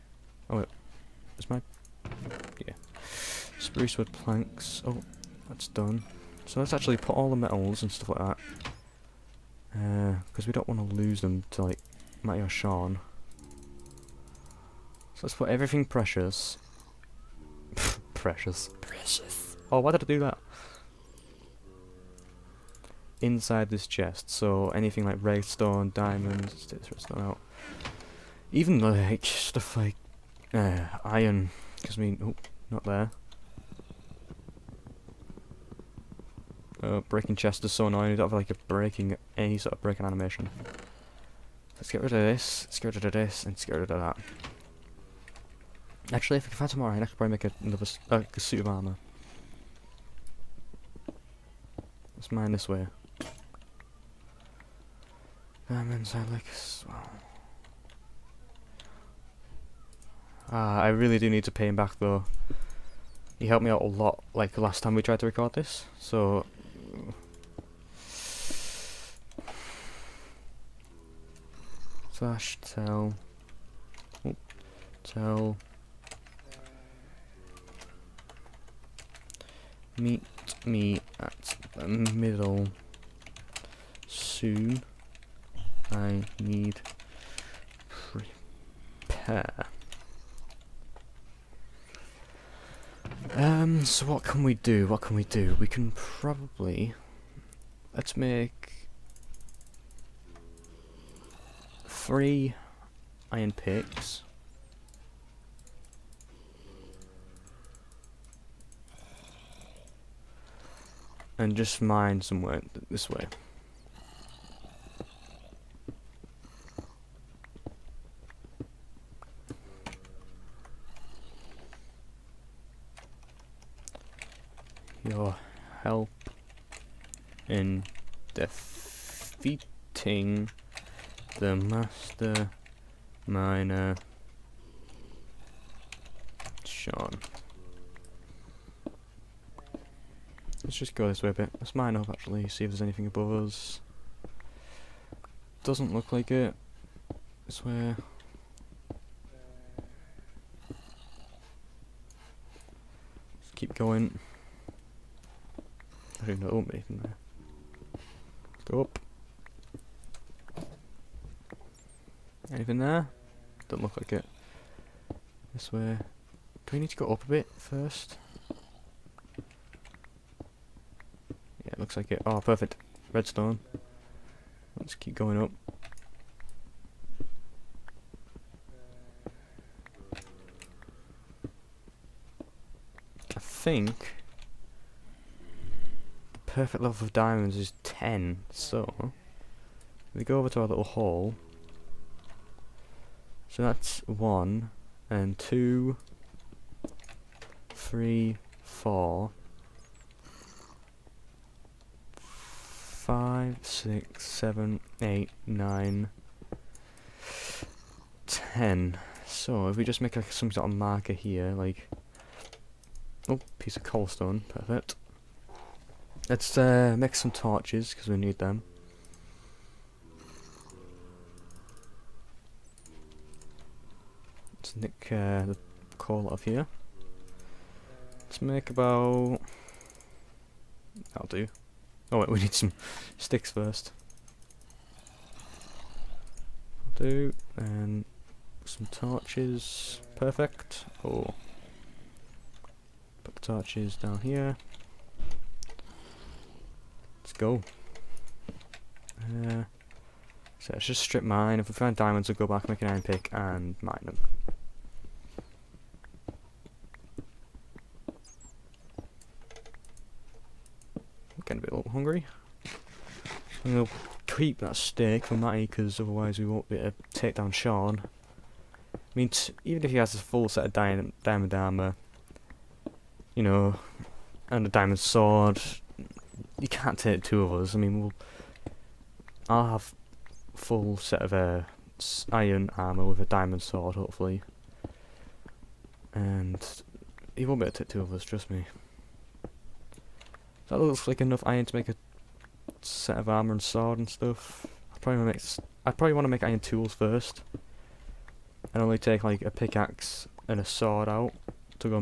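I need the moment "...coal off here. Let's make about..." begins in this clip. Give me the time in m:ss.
3:45.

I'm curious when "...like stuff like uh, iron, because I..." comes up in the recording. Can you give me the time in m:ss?
0:28.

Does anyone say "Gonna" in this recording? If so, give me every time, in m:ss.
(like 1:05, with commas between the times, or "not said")
4:21.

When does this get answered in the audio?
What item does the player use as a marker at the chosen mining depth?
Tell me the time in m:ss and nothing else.
3:33.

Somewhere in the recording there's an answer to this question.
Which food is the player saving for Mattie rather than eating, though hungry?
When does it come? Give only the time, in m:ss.
4:24.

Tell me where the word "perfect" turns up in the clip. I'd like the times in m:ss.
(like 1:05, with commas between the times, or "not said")
2:52, 3:06, 3:34, 4:00.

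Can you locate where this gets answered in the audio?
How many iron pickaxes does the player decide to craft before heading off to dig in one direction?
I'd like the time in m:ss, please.
1:41.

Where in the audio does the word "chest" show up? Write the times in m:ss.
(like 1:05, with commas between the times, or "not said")
0:23, 0:37.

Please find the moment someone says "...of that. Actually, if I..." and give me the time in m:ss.
0:43.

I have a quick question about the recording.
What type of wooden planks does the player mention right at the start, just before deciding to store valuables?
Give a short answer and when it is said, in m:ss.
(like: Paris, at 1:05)
Spruce wood planks, at 0:03.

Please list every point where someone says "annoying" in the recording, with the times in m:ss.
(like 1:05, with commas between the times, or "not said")
0:37.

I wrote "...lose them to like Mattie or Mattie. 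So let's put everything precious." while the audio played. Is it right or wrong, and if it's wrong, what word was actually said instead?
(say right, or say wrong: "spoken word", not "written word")
wrong: "Sean", not "Mattie".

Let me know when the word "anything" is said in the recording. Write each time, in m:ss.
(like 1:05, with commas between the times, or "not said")
0:24, 2:22, 2:42.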